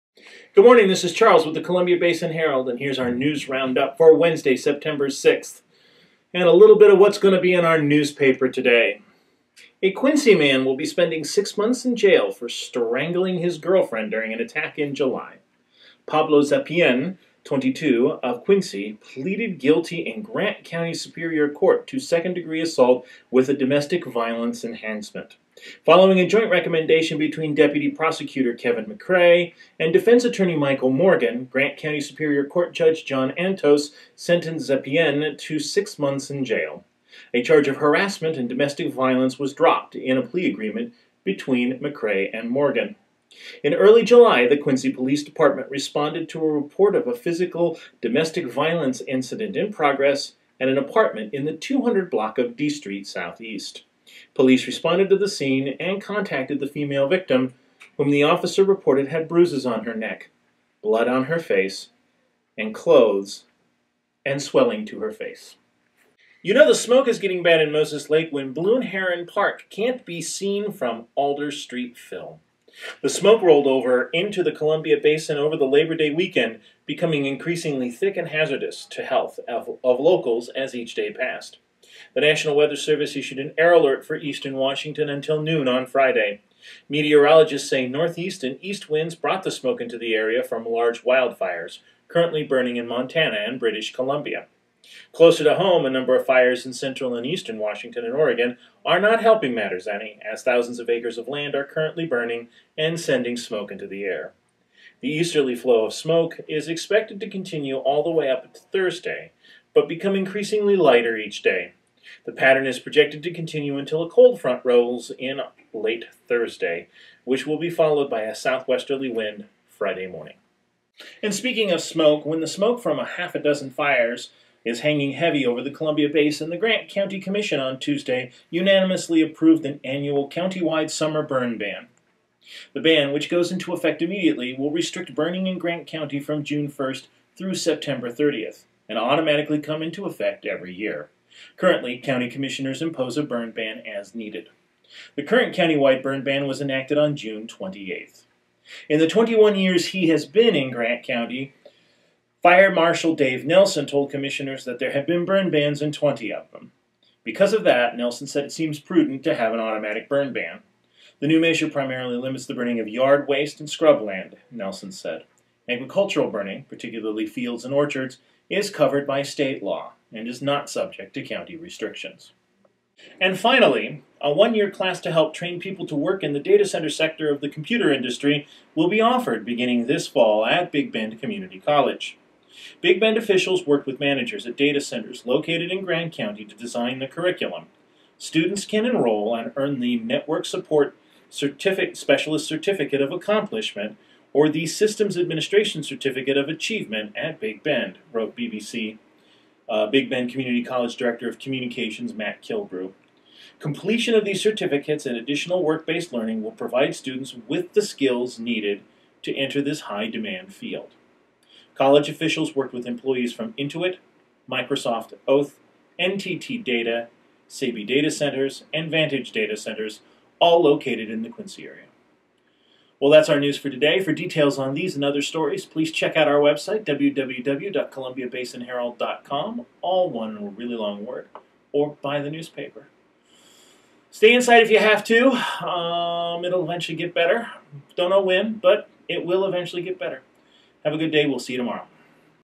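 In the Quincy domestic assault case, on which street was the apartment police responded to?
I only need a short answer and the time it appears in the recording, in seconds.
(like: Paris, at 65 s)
D Street Southeast, at 52 s.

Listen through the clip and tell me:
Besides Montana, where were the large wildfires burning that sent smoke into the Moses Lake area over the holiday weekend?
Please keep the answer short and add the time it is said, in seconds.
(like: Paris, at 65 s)
British Columbia, at 93 s.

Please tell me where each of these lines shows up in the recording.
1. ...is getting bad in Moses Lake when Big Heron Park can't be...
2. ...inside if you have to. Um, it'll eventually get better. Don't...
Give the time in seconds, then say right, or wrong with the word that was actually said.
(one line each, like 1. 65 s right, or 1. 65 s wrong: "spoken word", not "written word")
1. 67 s wrong: "Blue", not "Big"
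2. 234 s right.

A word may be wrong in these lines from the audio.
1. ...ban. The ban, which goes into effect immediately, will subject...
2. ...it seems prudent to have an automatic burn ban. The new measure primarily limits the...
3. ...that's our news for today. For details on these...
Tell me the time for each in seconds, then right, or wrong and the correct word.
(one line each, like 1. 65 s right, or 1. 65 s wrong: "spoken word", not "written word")
1. 131 s wrong: "restrict", not "subject"
2. 158 s right
3. 223 s right.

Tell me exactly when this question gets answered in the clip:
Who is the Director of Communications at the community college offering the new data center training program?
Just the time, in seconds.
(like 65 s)
202 s.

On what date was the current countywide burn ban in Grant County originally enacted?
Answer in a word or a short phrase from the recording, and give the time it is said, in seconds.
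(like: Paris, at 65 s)
June 28th, at 147 s.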